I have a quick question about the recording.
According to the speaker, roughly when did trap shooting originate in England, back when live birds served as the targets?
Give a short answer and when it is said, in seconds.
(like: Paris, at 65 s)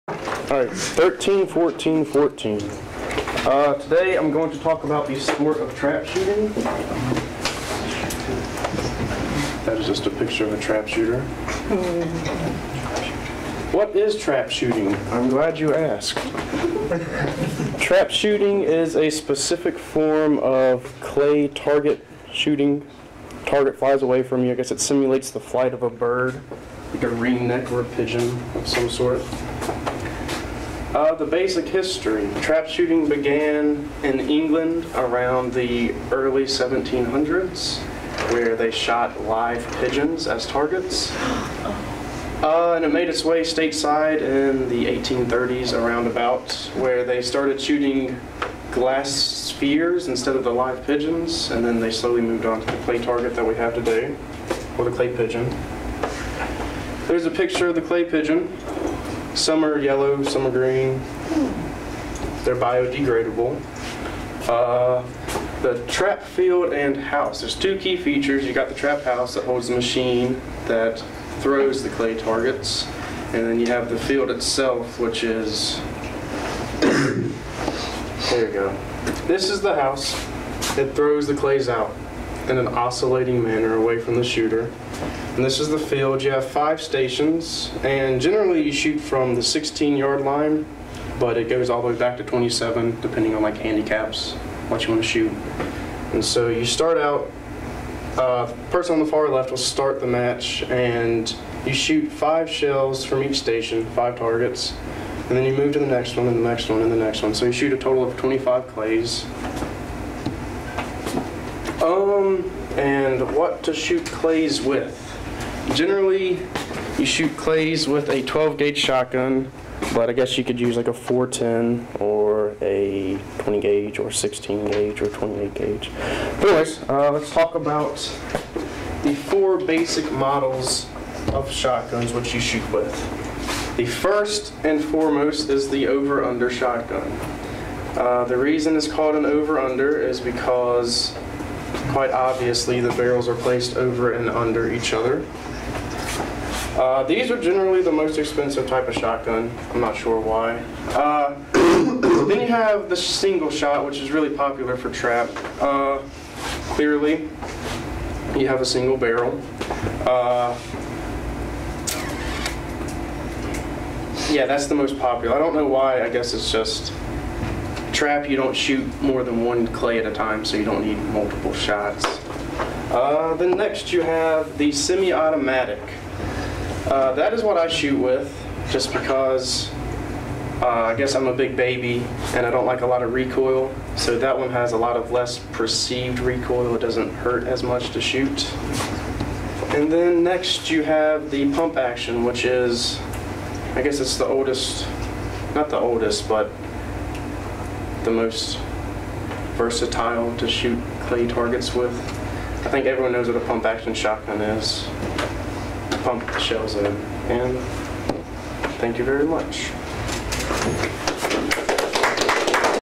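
early 1700s, at 36 s.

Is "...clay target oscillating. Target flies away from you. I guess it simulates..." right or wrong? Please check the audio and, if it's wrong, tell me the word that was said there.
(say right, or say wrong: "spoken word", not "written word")
wrong: "shooting", not "oscillating".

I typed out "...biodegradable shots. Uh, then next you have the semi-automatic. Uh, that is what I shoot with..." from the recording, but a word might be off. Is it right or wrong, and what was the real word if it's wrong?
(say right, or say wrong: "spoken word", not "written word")
wrong: "multiple", not "biodegradable".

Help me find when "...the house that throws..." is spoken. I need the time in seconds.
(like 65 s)
79 s.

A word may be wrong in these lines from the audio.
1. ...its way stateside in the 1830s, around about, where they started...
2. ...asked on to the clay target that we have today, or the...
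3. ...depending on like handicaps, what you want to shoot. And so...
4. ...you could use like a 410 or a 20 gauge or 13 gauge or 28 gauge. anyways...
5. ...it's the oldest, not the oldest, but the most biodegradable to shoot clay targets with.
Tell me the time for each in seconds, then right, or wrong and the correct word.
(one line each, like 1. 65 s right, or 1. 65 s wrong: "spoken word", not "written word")
1. 43 s right
2. 52 s wrong: "moved", not "asked"
3. 93 s right
4. 120 s wrong: "16", not "13"
5. 193 s wrong: "versatile", not "biodegradable".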